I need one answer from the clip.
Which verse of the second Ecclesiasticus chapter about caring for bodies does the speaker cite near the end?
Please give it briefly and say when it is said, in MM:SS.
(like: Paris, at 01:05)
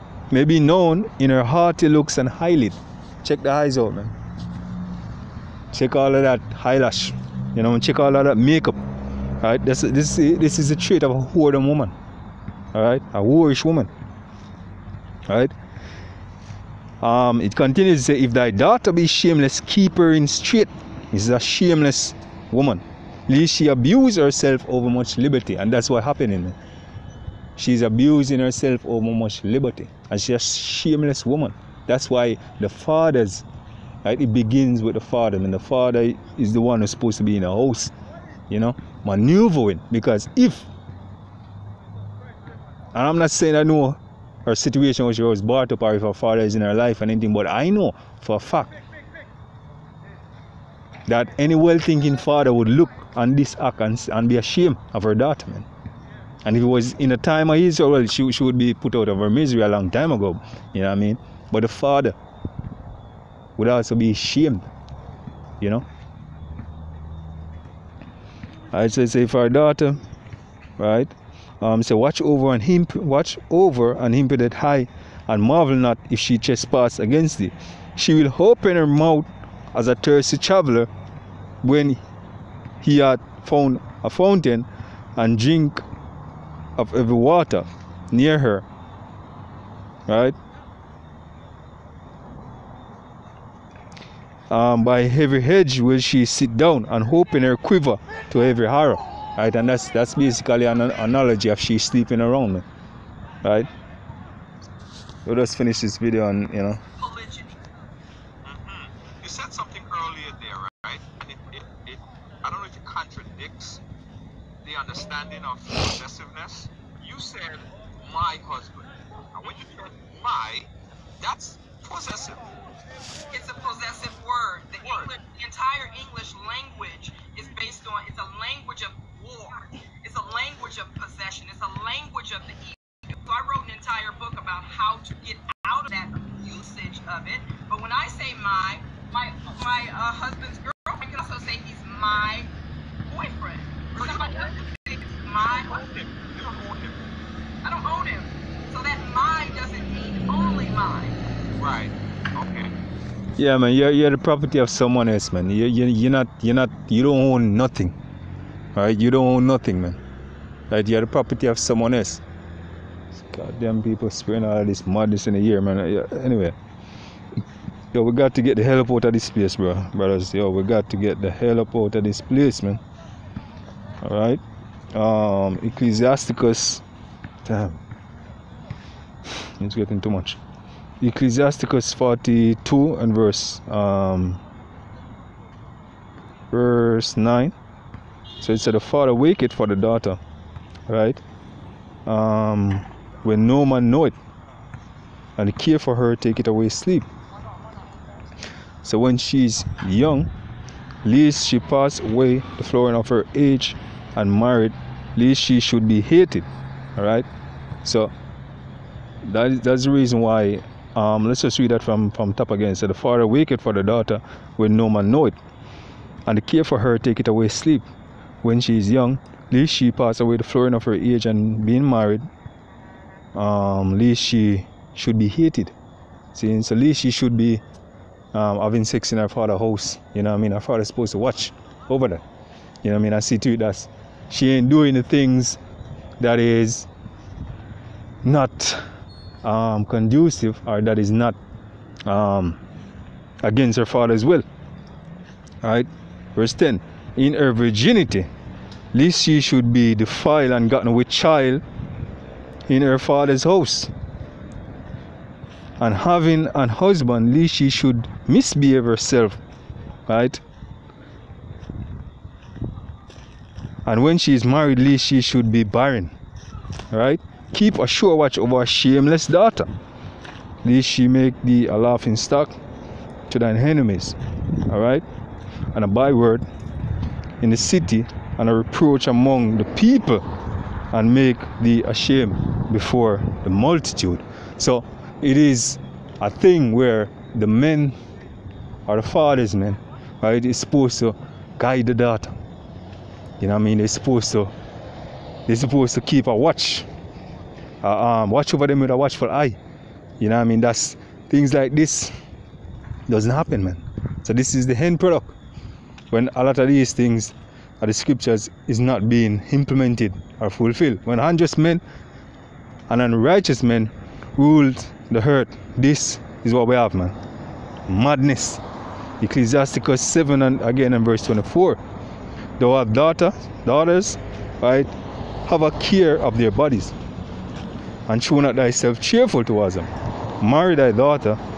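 24, at 05:21.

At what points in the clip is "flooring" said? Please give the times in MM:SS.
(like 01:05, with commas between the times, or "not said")
03:22, 03:40.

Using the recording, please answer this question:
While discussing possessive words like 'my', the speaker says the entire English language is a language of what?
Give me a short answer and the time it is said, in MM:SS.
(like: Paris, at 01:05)
war, at 02:09.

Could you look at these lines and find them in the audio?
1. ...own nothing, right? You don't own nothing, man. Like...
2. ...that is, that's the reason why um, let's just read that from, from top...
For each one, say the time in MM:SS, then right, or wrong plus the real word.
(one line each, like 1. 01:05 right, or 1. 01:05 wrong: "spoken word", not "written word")
1. 02:37 right
2. 03:29 right.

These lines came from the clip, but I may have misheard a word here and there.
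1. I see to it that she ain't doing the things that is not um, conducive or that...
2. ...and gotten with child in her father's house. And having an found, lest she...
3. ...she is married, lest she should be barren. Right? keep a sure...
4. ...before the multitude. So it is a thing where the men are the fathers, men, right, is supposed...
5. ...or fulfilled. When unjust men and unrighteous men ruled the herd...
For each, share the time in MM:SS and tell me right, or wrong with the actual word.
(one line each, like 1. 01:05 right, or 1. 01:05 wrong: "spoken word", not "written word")
1. 03:53 right
2. 04:10 wrong: "husband", not "found"
3. 04:24 right
4. 04:42 right
5. 05:10 right.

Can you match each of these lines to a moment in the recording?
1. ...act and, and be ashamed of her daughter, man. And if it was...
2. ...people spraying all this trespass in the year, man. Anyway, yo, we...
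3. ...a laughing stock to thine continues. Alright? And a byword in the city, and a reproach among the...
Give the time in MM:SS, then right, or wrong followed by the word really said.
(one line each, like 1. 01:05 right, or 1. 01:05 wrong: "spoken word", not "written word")
1. 00:53 right
2. 02:43 wrong: "madness", not "trespass"
3. 04:31 wrong: "enemies", not "continues".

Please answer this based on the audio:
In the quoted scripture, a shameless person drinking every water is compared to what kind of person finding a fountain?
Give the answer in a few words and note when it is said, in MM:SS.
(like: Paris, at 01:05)
a thirsty traveler, at 01:19.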